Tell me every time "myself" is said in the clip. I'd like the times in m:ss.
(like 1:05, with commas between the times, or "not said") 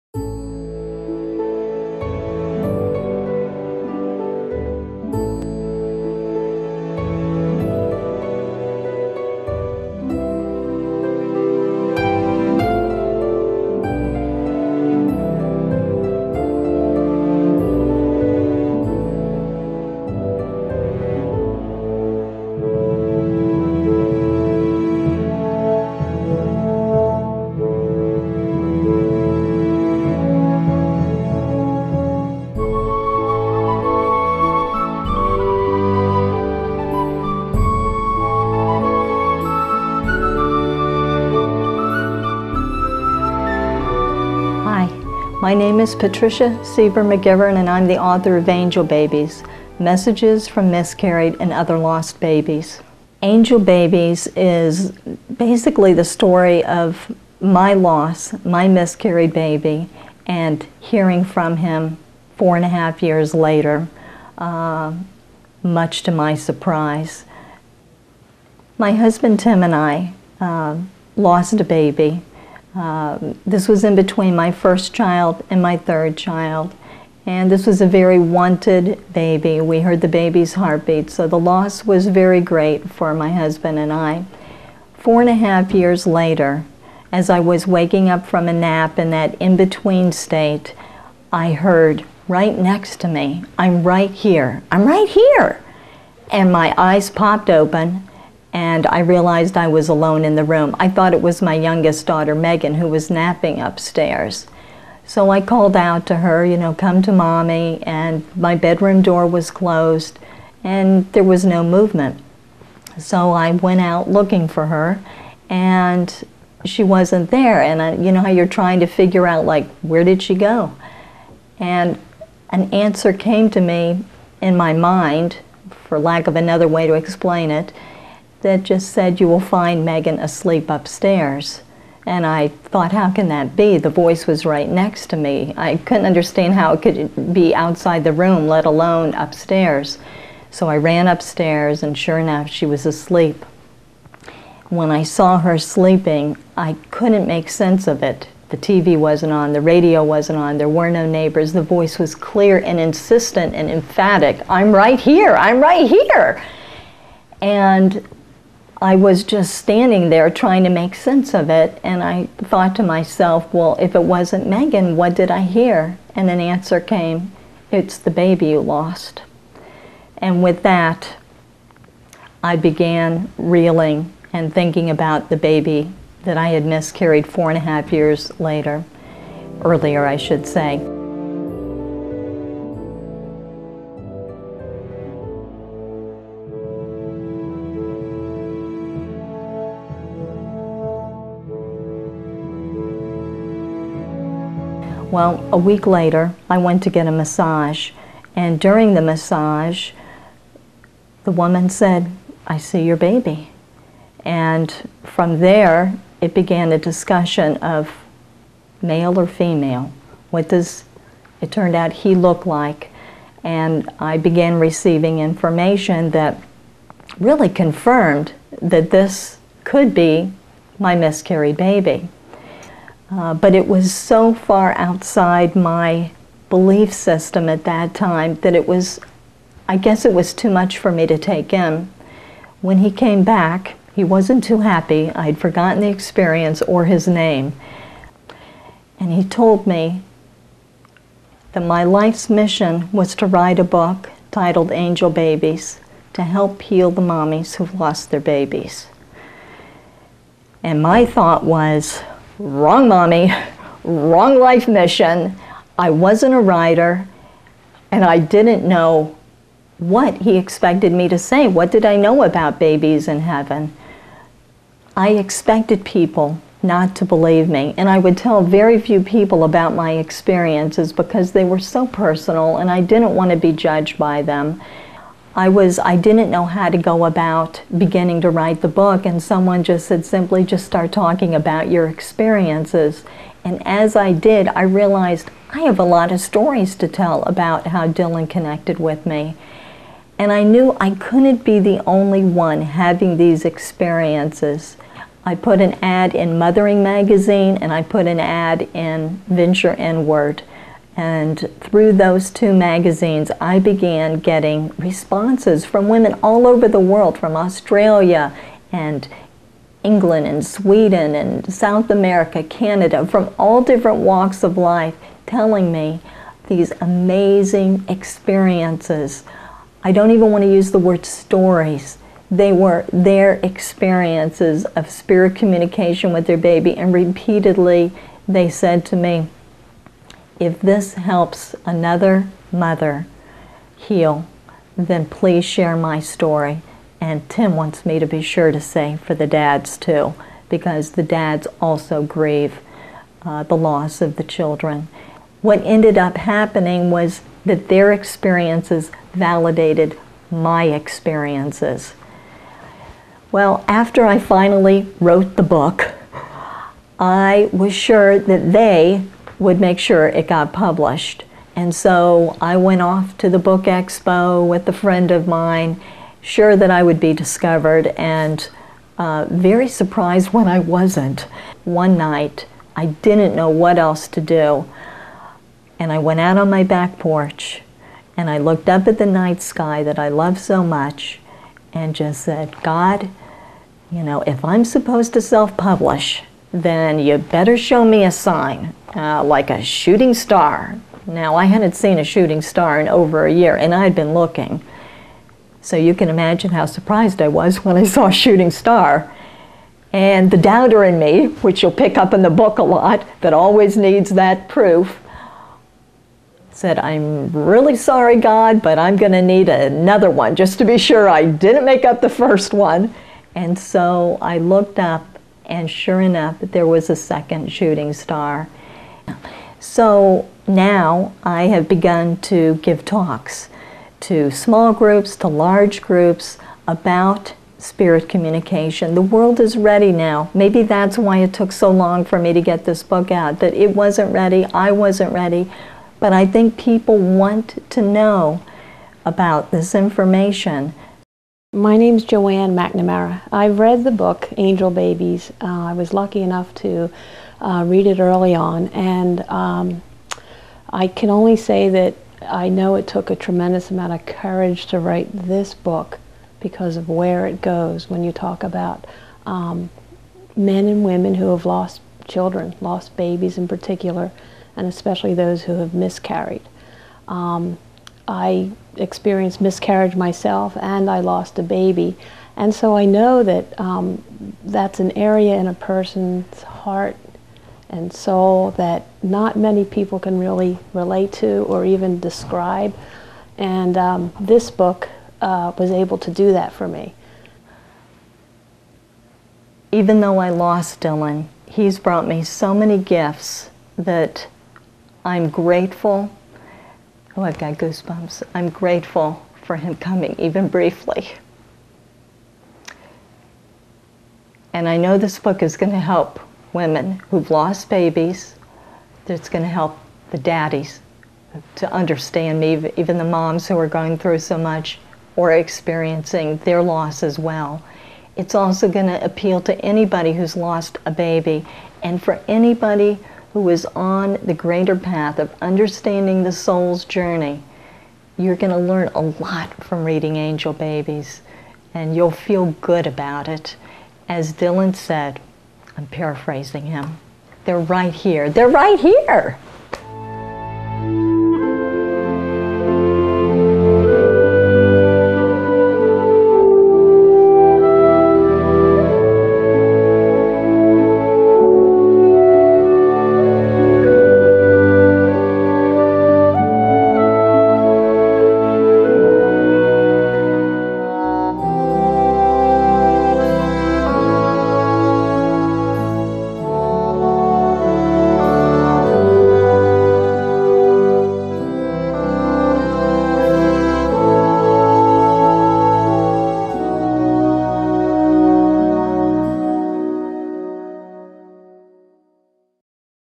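2:42, 7:49.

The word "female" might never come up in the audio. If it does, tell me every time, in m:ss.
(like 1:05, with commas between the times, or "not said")
3:29.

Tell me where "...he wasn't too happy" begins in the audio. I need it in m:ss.
3:53.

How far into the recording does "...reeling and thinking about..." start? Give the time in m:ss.
2:53.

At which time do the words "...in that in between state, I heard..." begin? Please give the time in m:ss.
1:28.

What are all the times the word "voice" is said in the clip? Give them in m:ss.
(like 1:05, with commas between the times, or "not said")
2:13, 2:31.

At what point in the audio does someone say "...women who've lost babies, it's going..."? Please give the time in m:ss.
8:26.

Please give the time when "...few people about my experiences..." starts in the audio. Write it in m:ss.
4:28.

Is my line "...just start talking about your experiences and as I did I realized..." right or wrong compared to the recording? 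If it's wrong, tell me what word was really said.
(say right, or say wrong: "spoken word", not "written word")
right.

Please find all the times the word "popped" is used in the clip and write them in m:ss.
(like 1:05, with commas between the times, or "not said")
1:37.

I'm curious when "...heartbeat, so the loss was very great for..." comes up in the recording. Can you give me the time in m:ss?
1:20.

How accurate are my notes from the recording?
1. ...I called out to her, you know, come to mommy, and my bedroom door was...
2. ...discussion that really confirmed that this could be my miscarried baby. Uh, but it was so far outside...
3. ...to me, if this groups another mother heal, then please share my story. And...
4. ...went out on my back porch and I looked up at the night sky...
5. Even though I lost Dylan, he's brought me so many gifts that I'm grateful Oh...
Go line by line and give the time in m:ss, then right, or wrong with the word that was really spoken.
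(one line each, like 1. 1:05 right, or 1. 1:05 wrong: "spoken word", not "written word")
1. 1:45 right
2. 3:35 wrong: "information", not "discussion"
3. 5:28 wrong: "helps", not "groups"
4. 6:15 right
5. 8:09 right.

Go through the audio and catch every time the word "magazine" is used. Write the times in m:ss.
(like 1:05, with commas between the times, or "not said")
4:56, 5:02.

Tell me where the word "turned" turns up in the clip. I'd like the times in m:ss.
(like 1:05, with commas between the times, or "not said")
3:31.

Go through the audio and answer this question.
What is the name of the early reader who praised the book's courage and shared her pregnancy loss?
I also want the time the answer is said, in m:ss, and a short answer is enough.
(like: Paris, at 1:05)
Joanne McNamara, at 7:22.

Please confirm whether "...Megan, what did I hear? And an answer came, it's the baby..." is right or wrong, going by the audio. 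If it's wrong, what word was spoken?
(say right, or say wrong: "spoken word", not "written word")
right.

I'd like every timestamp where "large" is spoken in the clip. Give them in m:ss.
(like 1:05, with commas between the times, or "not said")
7:05.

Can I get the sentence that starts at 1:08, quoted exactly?
My husband Tim and I uh, lost a baby um, this was in between my first child and my third child.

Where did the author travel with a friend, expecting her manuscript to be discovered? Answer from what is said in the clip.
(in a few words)
The book expo.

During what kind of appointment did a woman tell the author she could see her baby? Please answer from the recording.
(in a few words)
A massage.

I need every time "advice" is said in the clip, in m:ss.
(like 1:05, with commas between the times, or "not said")
not said.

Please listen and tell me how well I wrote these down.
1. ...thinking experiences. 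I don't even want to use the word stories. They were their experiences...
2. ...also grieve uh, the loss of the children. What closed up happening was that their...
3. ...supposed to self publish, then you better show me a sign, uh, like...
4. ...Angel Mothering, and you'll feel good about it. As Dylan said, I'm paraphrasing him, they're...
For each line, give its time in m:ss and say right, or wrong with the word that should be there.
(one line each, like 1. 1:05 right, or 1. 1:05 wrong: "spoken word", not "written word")
1. 5:16 wrong: "amazing", not "thinking"
2. 5:41 wrong: "ended", not "closed"
3. 6:24 right
4. 8:50 wrong: "Babies", not "Mothering".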